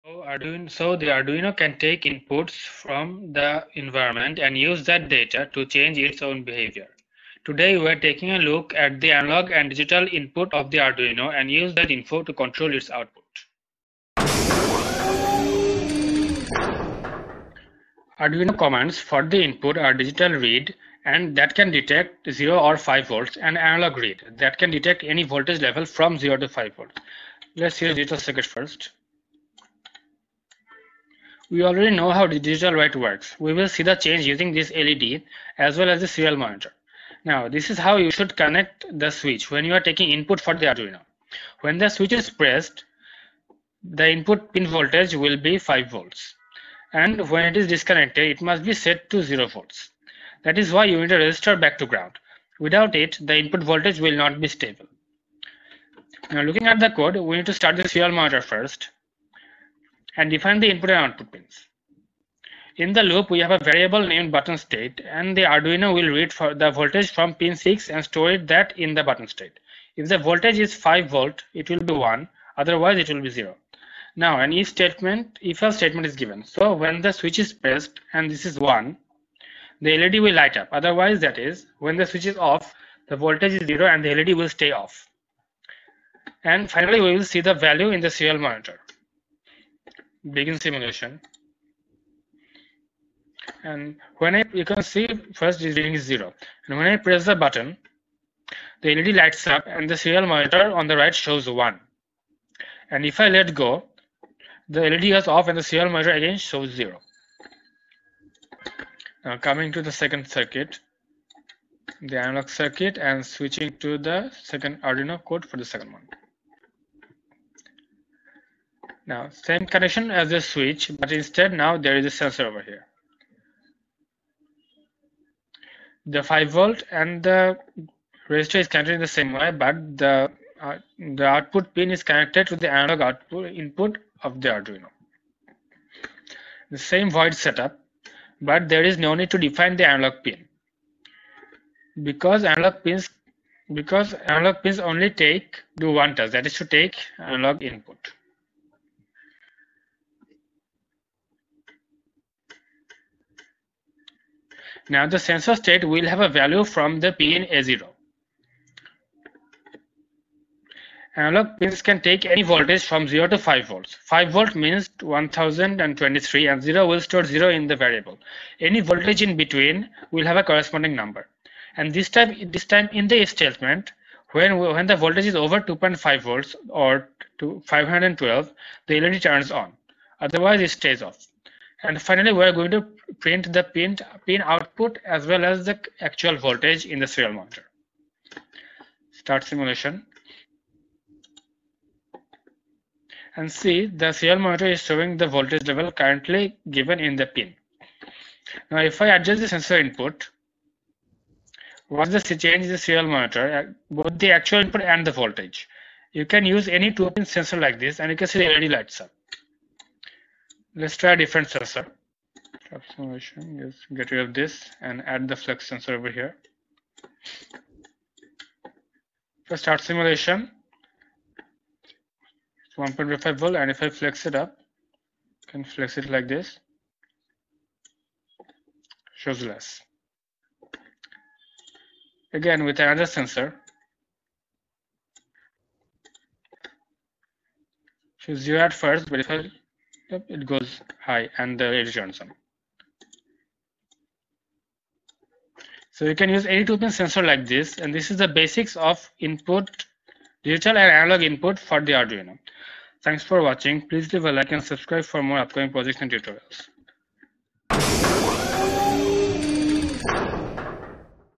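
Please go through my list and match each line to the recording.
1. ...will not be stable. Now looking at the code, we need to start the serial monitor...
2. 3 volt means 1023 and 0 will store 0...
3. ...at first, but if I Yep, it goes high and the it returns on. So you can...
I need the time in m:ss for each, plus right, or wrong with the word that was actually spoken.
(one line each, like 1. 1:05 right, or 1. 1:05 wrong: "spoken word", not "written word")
1. 0:53 right
2. 2:43 wrong: "5", not "3"
3. 3:58 right.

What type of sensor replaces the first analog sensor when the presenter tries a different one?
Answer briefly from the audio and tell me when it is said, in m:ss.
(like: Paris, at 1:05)
Flex sensor, at 3:35.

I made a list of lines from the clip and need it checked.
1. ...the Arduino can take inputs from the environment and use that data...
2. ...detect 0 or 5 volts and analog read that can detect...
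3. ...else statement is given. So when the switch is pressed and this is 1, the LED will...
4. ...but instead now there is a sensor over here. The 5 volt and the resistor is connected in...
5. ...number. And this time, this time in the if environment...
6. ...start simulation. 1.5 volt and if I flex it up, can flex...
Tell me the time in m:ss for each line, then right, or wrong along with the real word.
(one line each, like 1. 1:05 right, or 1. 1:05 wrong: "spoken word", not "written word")
1. 0:00 right
2. 0:21 right
3. 1:15 right
4. 2:00 right
5. 2:50 wrong: "statement", not "environment"
6. 3:39 right.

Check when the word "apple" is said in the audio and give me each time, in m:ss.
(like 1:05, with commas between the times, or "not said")
not said.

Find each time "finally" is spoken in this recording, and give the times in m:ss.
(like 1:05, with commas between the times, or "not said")
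1:26, 3:02.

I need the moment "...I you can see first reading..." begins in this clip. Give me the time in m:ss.
1:34.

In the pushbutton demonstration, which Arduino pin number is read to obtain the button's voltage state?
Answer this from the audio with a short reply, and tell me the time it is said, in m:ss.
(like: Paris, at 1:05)
6, at 1:07.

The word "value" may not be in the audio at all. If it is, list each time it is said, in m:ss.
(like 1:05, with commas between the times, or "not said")
1:27, 2:36.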